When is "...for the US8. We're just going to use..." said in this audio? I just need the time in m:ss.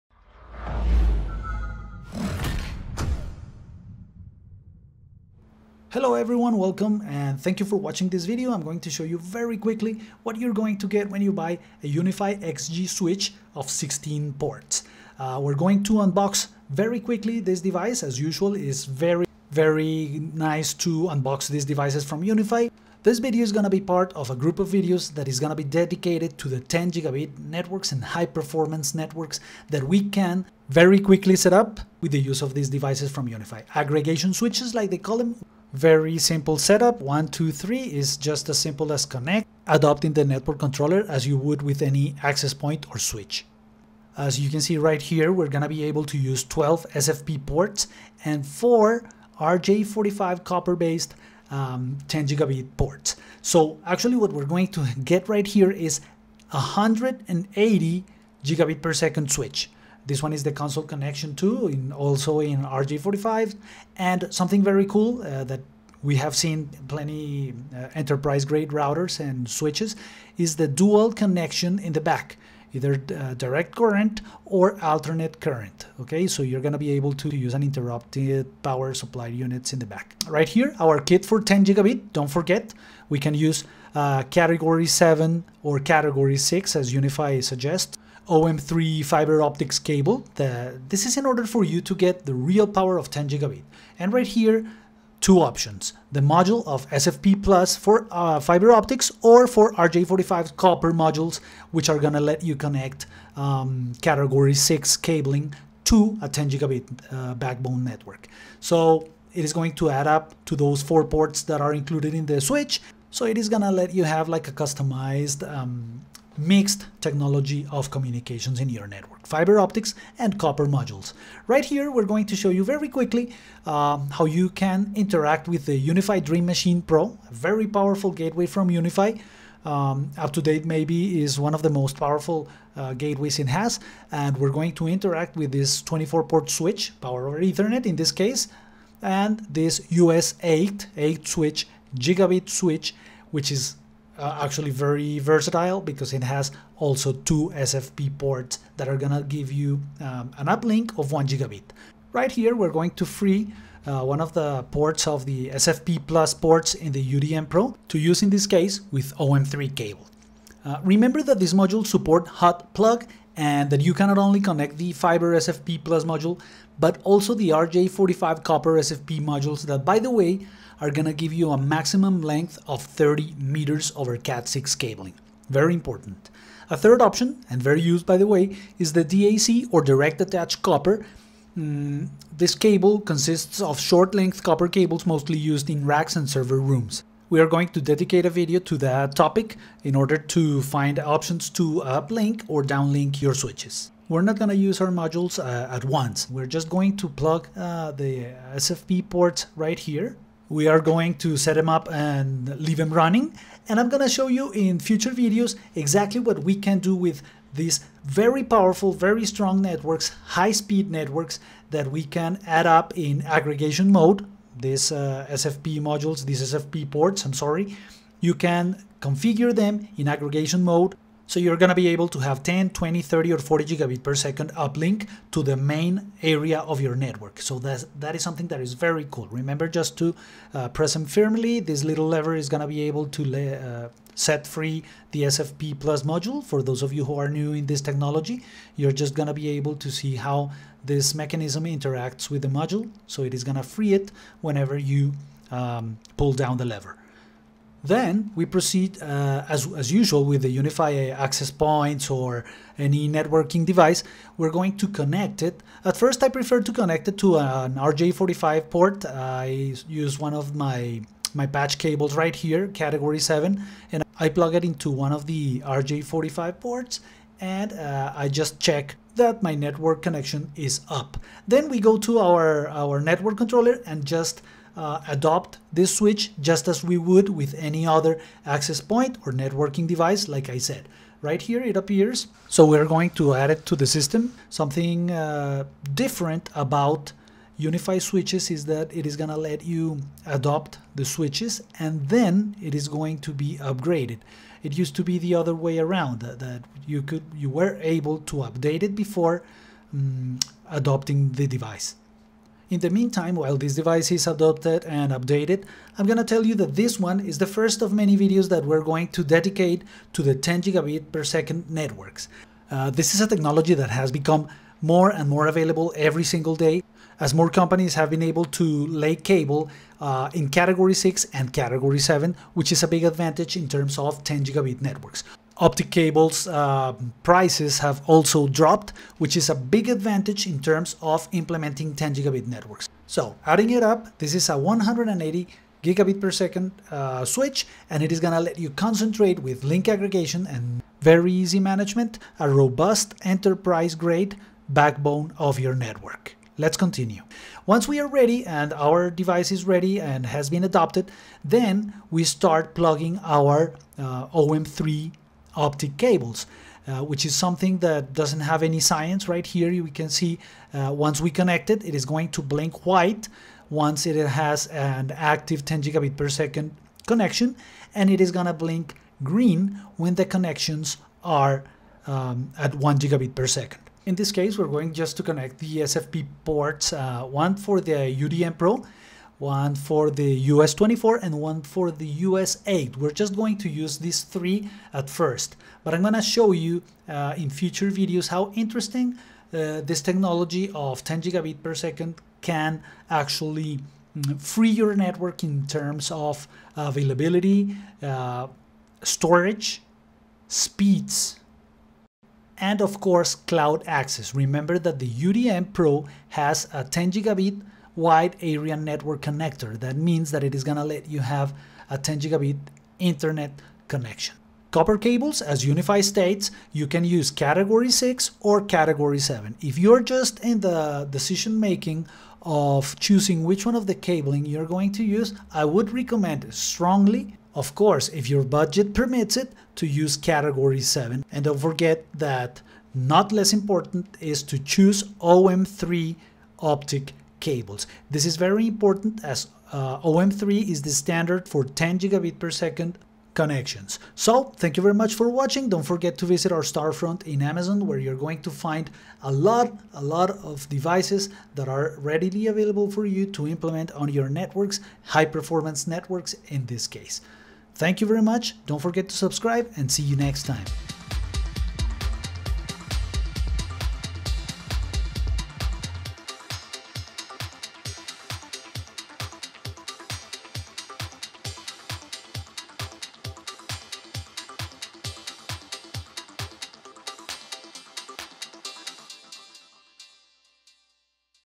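6:21.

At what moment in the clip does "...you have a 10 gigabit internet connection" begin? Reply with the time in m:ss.
6:51.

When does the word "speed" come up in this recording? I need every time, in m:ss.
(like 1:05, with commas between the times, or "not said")
3:30, 6:40.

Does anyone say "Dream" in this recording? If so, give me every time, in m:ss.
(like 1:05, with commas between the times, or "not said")
2:06.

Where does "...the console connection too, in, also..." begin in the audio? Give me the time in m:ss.
1:00.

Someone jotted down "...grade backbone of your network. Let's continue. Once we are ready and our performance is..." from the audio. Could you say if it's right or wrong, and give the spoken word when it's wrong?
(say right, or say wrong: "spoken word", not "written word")
wrong: "device", not "performance".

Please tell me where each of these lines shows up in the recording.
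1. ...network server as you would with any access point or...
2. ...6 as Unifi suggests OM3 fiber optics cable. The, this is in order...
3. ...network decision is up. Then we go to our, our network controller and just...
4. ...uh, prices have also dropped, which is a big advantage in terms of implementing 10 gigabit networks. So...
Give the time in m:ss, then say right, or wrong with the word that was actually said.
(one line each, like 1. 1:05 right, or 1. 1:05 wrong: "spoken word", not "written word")
1. 0:40 wrong: "controller", not "server"
2. 1:26 right
3. 4:29 wrong: "connection", not "decision"
4. 5:26 right.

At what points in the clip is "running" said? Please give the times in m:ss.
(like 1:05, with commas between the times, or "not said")
3:22.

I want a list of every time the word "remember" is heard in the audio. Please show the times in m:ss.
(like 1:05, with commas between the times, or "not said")
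2:40, 3:49, 6:44.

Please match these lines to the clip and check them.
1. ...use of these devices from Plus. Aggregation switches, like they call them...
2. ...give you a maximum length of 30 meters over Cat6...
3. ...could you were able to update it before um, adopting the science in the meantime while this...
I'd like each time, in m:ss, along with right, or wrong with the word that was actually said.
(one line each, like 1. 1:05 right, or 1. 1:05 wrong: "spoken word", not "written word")
1. 0:32 wrong: "Unifi", not "Plus"
2. 2:51 right
3. 4:57 wrong: "device", not "science".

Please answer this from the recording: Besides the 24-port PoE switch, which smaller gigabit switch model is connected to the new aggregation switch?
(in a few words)
US-8.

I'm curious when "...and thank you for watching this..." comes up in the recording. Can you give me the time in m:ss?
0:07.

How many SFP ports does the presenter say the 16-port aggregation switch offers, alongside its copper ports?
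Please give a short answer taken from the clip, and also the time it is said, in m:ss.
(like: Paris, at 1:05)
12, at 0:46.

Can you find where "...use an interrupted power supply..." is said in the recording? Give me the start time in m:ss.
1:17.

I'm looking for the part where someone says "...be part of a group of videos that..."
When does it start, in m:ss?
0:23.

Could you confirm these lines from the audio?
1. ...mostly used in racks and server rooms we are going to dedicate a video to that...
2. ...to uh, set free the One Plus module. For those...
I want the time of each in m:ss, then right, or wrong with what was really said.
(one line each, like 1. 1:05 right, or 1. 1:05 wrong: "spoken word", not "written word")
1. 3:05 right
2. 3:53 wrong: "SFP", not "One".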